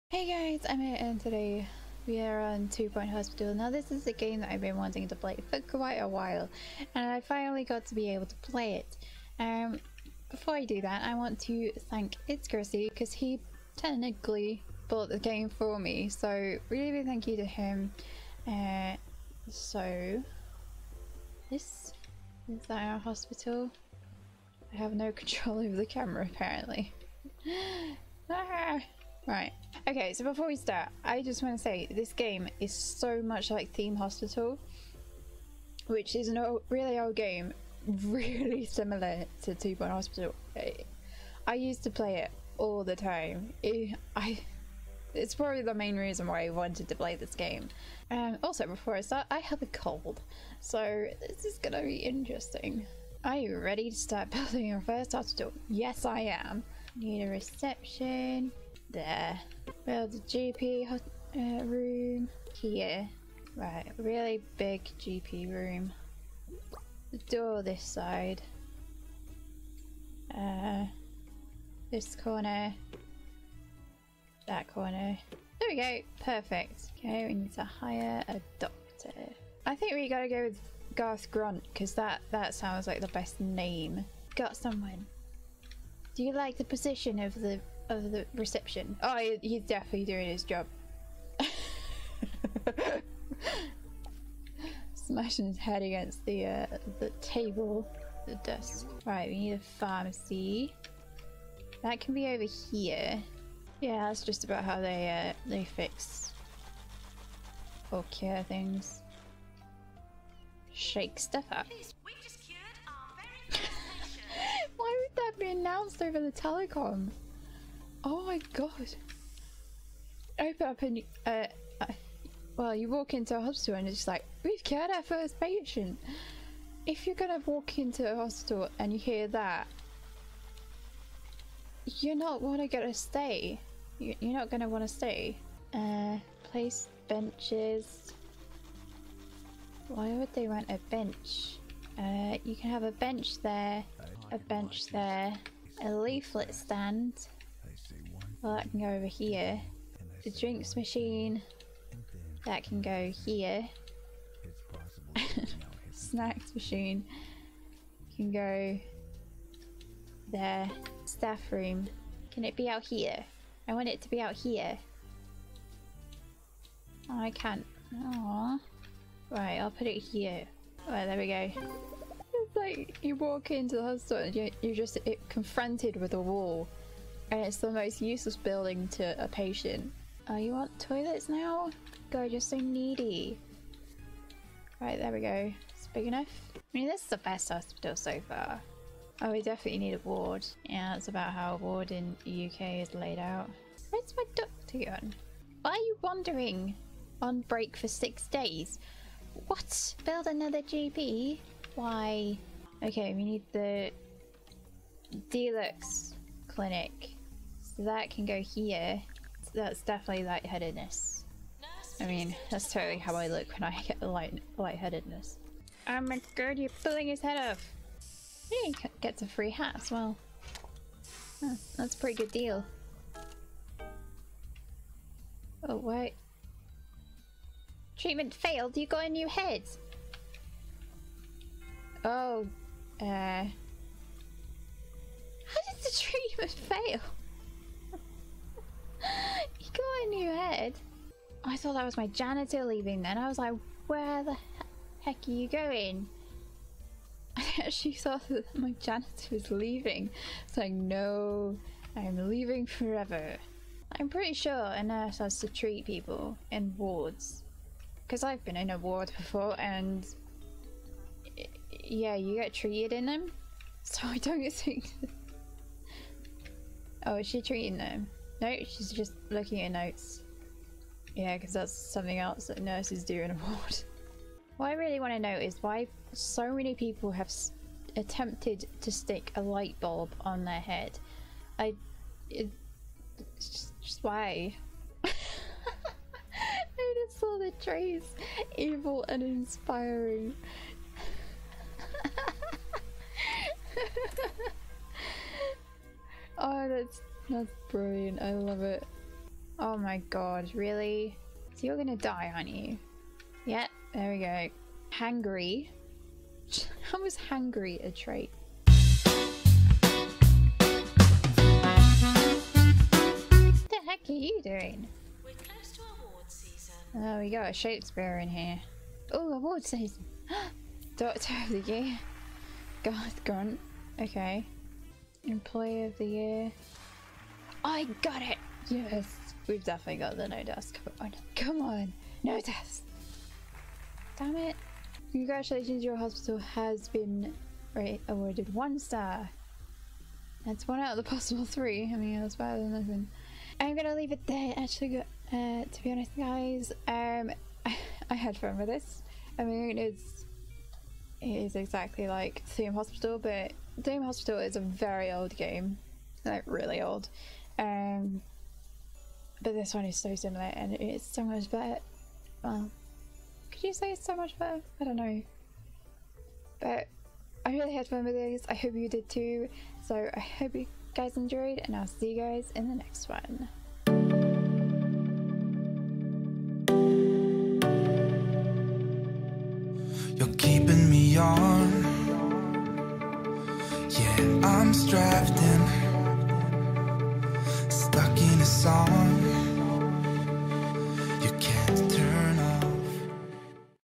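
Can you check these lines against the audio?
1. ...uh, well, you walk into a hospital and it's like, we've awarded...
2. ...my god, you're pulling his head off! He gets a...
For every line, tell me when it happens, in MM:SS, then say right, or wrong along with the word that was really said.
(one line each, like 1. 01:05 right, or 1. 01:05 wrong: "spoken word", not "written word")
1. 02:01 wrong: "cured", not "awarded"
2. 03:36 right.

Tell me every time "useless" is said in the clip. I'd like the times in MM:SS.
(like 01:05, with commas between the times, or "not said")
02:58.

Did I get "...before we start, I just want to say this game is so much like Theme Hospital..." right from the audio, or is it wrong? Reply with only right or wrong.
right.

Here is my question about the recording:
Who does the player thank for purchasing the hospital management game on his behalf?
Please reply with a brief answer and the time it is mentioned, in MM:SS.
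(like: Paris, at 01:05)
ItsChrissyy, at 00:12.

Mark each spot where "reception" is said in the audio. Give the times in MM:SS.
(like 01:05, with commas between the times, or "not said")
00:57, 01:28.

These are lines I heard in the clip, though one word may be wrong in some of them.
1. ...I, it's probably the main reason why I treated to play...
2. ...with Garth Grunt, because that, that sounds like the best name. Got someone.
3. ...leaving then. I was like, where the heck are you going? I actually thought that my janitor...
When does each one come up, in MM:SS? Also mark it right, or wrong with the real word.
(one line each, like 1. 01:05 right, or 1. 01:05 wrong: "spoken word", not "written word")
1. 00:44 wrong: "wanted", not "treated"
2. 01:20 right
3. 04:02 right.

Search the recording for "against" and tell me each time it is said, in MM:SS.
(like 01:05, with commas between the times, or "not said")
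01:35.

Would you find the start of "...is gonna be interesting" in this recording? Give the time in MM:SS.
00:51.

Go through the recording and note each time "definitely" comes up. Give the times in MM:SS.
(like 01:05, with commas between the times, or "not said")
01:29, 03:09, 03:29, 05:29.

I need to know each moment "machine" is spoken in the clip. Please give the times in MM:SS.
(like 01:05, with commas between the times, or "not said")
02:30, 02:36.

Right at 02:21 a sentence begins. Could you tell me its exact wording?
Uh, you can have a bench there, a bench there, a leaflet stand.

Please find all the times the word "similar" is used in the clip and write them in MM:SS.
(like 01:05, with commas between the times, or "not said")
00:38, 06:00.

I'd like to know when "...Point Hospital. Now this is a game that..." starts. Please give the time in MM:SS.
00:02.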